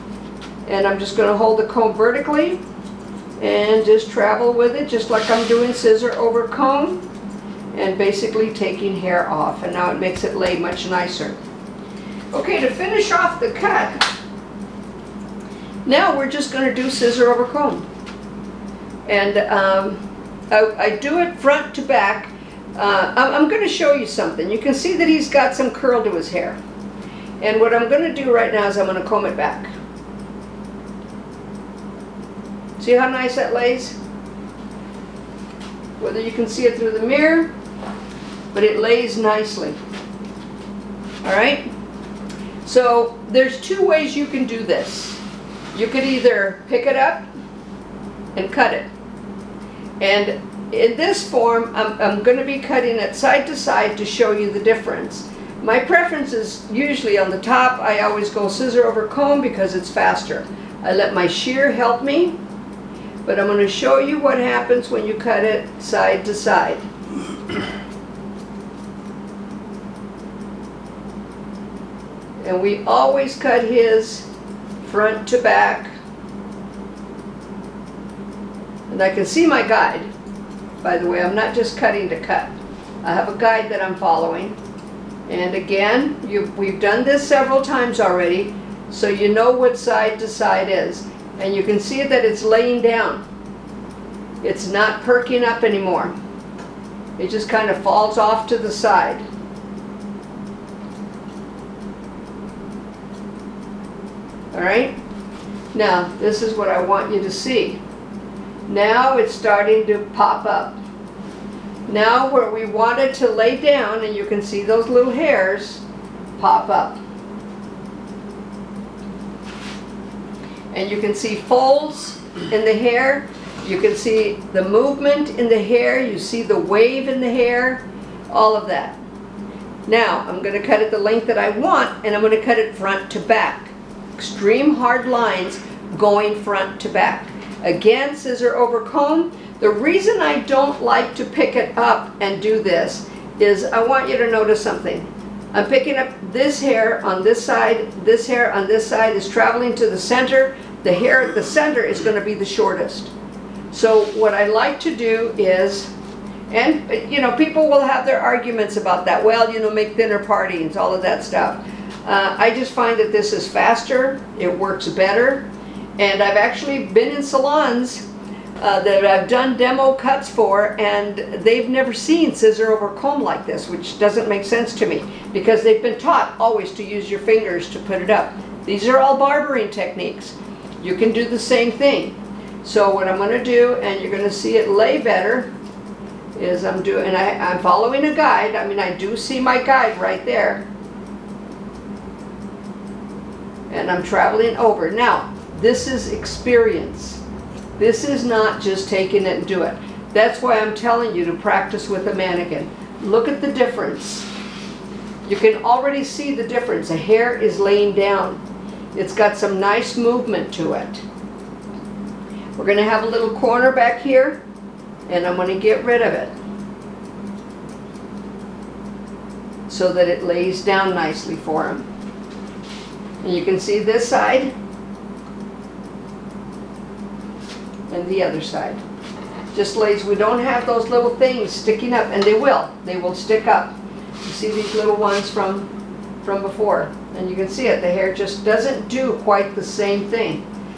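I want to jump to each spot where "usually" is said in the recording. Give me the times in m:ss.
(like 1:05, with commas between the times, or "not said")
0:56.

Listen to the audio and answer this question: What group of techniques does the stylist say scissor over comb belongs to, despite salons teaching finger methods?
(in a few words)
Barbering techniques.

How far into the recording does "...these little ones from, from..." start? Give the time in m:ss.
3:54.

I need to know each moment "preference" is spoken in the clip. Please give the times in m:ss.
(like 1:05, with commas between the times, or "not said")
0:55.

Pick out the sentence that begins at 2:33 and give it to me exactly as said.
So what I like to do is, and you know, people will have their arguments about that.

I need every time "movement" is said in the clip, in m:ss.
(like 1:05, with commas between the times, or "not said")
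2:04, 3:29.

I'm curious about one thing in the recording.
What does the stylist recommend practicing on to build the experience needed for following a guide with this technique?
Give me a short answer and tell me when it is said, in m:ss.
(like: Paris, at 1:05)
A mannequin, at 3:21.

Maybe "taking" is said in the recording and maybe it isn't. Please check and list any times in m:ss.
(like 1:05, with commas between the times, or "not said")
0:08, 3:18.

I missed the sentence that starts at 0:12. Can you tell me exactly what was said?
Okay, to finish off the cut, now we're just going to do scissor over comb.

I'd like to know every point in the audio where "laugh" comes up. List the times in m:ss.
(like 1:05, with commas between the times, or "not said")
not said.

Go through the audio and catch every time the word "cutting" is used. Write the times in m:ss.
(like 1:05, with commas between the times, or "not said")
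0:52, 1:21.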